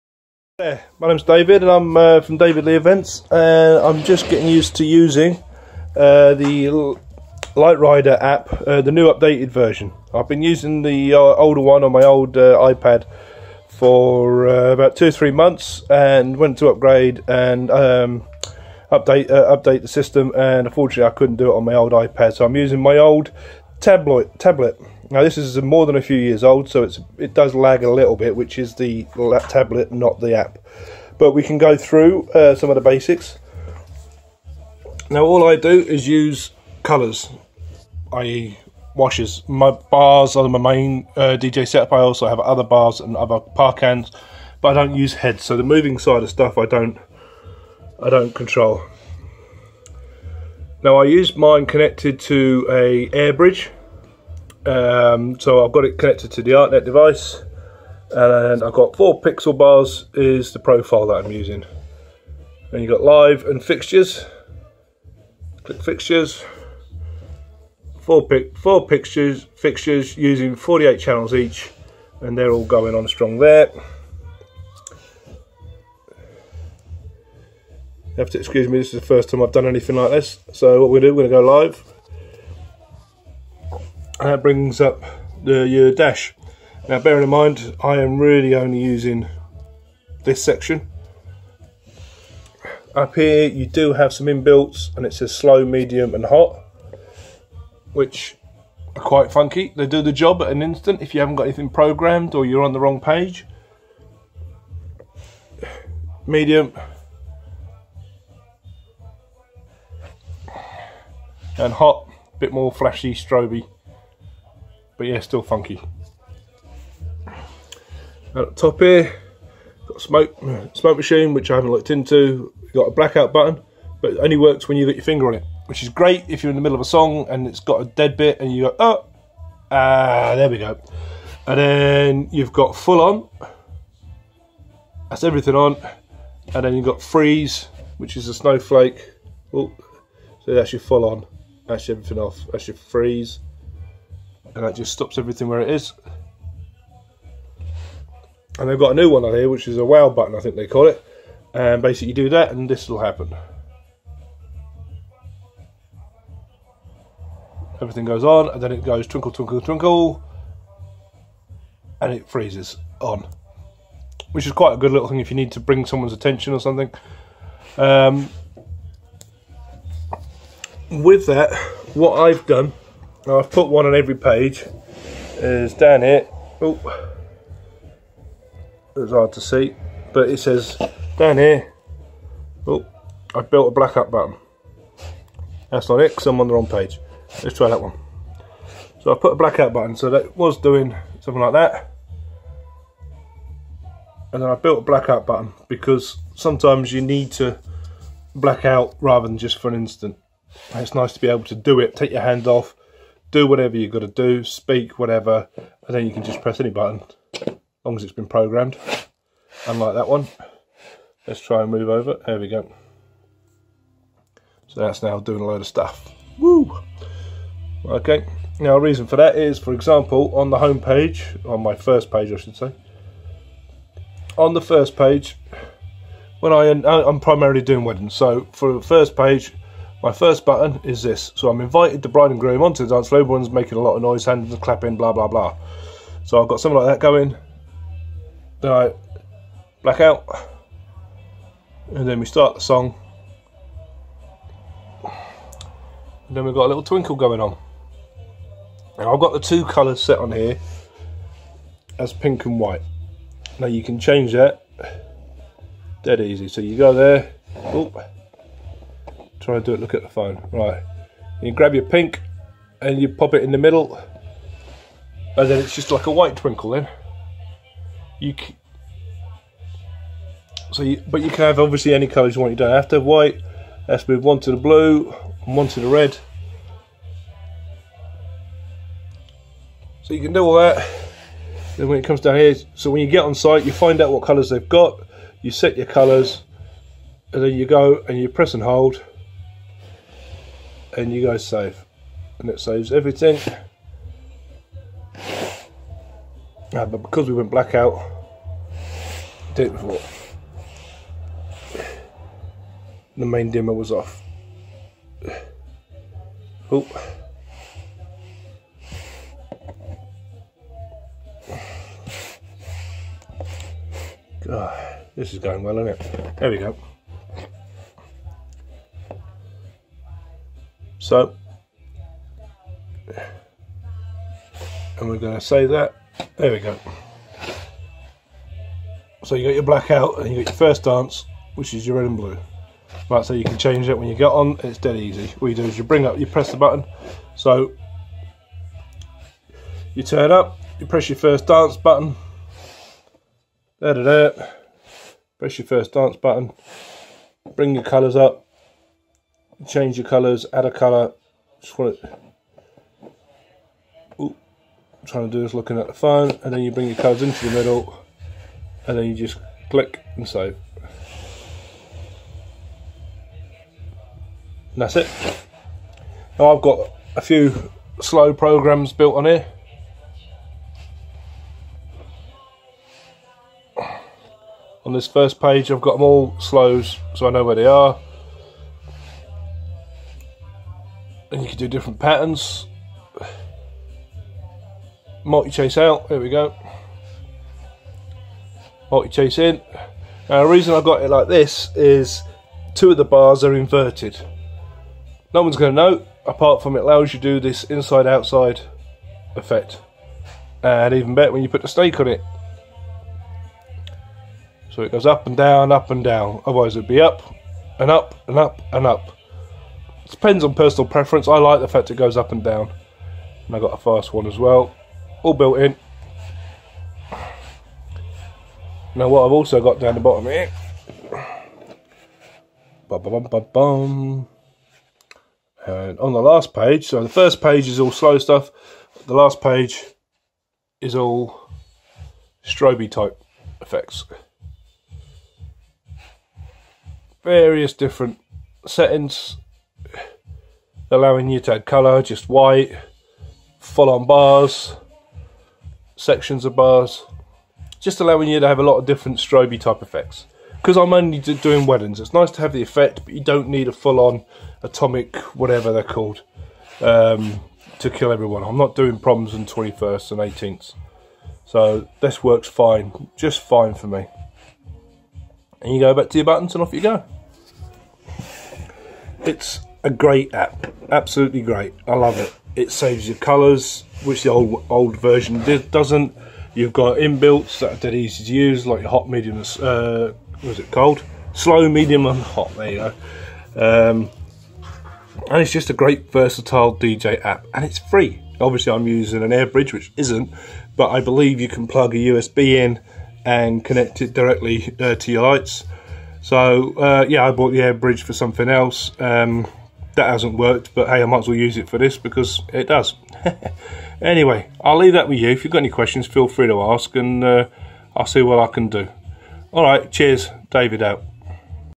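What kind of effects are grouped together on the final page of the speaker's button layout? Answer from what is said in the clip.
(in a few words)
Stroby type effects.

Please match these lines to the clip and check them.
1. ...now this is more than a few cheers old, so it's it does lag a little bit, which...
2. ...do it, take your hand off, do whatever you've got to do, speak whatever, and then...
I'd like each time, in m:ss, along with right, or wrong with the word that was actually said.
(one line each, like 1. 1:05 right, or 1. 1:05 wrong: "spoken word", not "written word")
1. 0:25 wrong: "years", not "cheers"
2. 3:21 right.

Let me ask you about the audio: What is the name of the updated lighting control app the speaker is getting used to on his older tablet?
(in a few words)
Light Rider.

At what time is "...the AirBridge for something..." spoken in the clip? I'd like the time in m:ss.
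8:17.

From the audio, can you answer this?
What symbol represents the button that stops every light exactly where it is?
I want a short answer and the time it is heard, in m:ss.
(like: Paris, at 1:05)
A snowflake, at 2:18.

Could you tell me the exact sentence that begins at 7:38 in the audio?
I'm not doing problems and 21st and 18th.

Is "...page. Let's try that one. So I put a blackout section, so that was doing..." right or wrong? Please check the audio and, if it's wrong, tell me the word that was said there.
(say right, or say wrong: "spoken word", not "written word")
wrong: "button", not "section".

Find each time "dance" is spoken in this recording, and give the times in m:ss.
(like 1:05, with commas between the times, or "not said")
3:52, 5:30, 5:41, 5:45.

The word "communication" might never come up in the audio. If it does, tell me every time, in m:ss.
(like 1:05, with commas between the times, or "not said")
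not said.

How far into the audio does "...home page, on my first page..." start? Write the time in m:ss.
3:40.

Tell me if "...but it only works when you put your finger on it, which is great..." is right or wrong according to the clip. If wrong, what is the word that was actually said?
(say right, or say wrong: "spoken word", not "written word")
right.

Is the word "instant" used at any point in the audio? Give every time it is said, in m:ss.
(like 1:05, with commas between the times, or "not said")
1:40, 3:19.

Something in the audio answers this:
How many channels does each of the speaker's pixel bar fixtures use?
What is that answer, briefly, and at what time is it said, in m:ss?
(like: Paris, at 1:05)
48, at 1:10.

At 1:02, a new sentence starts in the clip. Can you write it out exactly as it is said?
And you've got live and fixtures.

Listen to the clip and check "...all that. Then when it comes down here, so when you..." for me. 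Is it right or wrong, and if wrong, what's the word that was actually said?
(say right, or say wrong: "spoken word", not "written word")
right.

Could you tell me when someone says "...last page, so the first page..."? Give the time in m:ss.
7:06.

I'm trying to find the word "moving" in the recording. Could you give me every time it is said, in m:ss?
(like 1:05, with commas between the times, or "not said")
0:45.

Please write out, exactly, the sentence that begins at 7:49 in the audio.
It's a great app, absolutely great.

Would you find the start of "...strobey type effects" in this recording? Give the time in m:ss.
7:29.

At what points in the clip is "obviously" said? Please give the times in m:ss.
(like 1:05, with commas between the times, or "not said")
4:31, 8:08.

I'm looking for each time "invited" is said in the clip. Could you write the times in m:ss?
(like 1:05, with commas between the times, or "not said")
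3:51.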